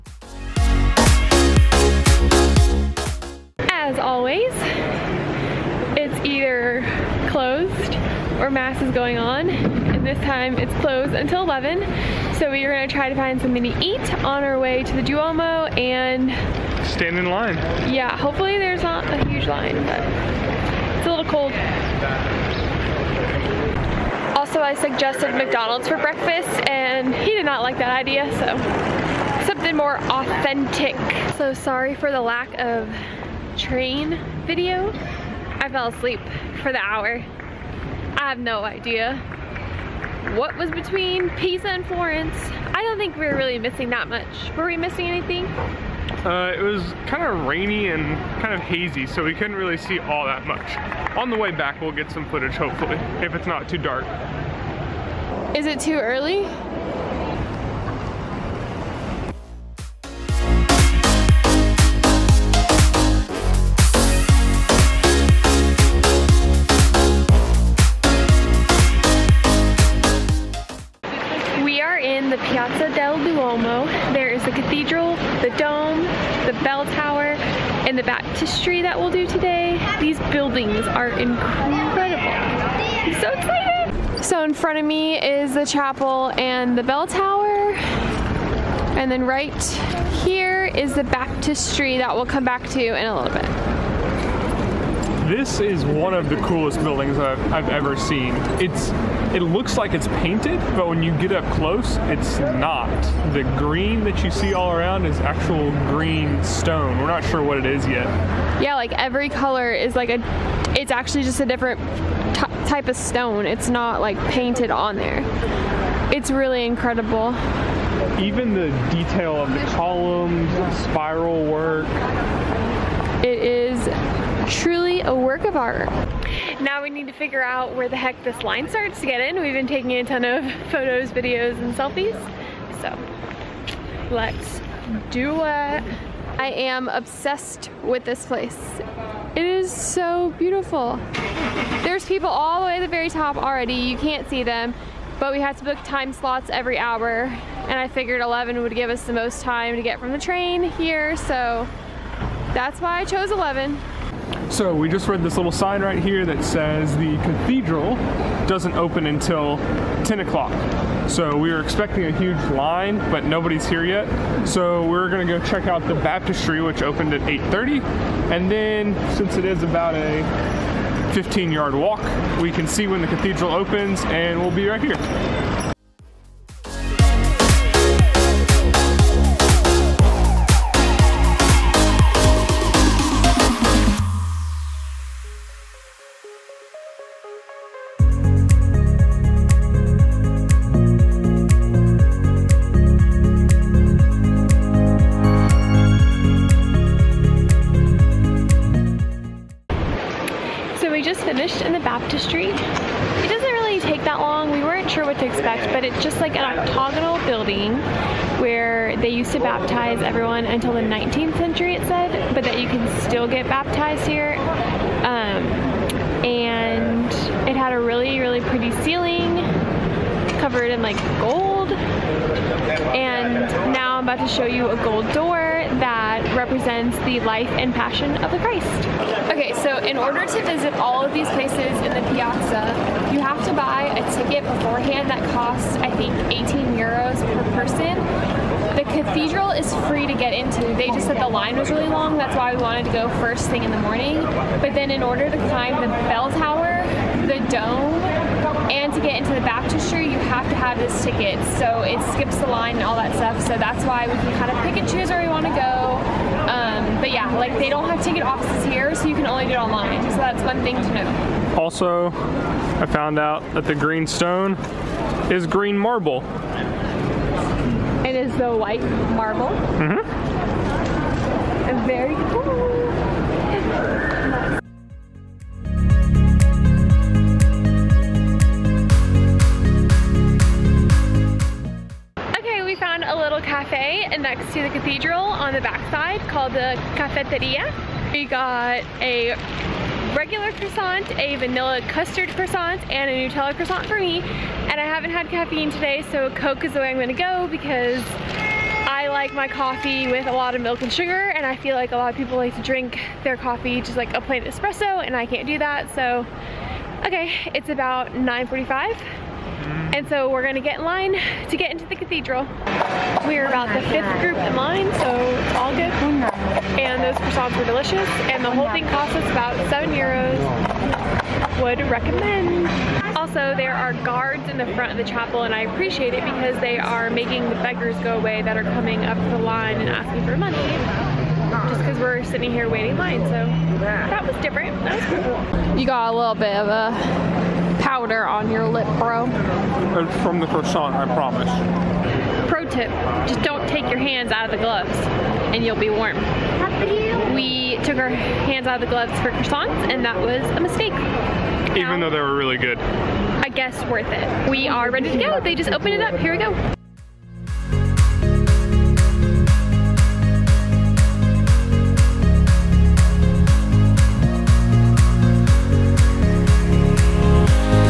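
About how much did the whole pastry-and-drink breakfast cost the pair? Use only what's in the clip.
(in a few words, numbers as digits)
7 euros.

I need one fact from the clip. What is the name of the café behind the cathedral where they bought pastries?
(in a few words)
the Cafeteria.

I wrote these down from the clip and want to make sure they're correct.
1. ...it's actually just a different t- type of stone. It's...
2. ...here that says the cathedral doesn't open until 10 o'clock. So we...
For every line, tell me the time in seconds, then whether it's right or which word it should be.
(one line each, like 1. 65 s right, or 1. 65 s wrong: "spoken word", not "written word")
1. 110 s right
2. 156 s right.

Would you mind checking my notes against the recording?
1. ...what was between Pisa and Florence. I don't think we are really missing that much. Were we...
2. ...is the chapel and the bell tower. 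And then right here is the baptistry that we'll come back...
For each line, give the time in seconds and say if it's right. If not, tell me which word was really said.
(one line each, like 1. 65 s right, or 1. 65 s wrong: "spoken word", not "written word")
1. 40 s right
2. 85 s right.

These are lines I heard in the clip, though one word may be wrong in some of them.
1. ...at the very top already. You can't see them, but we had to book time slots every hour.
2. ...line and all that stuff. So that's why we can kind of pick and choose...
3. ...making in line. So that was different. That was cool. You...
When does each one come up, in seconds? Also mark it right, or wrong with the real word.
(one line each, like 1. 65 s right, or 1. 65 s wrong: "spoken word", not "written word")
1. 142 s right
2. 252 s right
3. 332 s wrong: "waiting", not "making".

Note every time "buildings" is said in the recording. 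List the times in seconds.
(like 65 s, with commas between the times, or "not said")
80 s, 96 s.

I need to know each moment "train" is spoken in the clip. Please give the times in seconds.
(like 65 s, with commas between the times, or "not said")
33 s, 150 s.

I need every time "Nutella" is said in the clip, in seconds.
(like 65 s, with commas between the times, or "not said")
293 s.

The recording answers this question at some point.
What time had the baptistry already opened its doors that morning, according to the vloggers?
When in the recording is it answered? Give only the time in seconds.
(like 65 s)
167 s.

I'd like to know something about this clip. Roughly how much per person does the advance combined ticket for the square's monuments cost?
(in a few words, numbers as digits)
18 euros.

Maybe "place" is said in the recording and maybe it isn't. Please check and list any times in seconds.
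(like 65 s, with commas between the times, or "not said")
138 s, 231 s.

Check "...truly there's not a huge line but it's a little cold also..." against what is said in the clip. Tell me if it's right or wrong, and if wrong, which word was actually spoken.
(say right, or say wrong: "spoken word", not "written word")
wrong: "hopefully", not "truly".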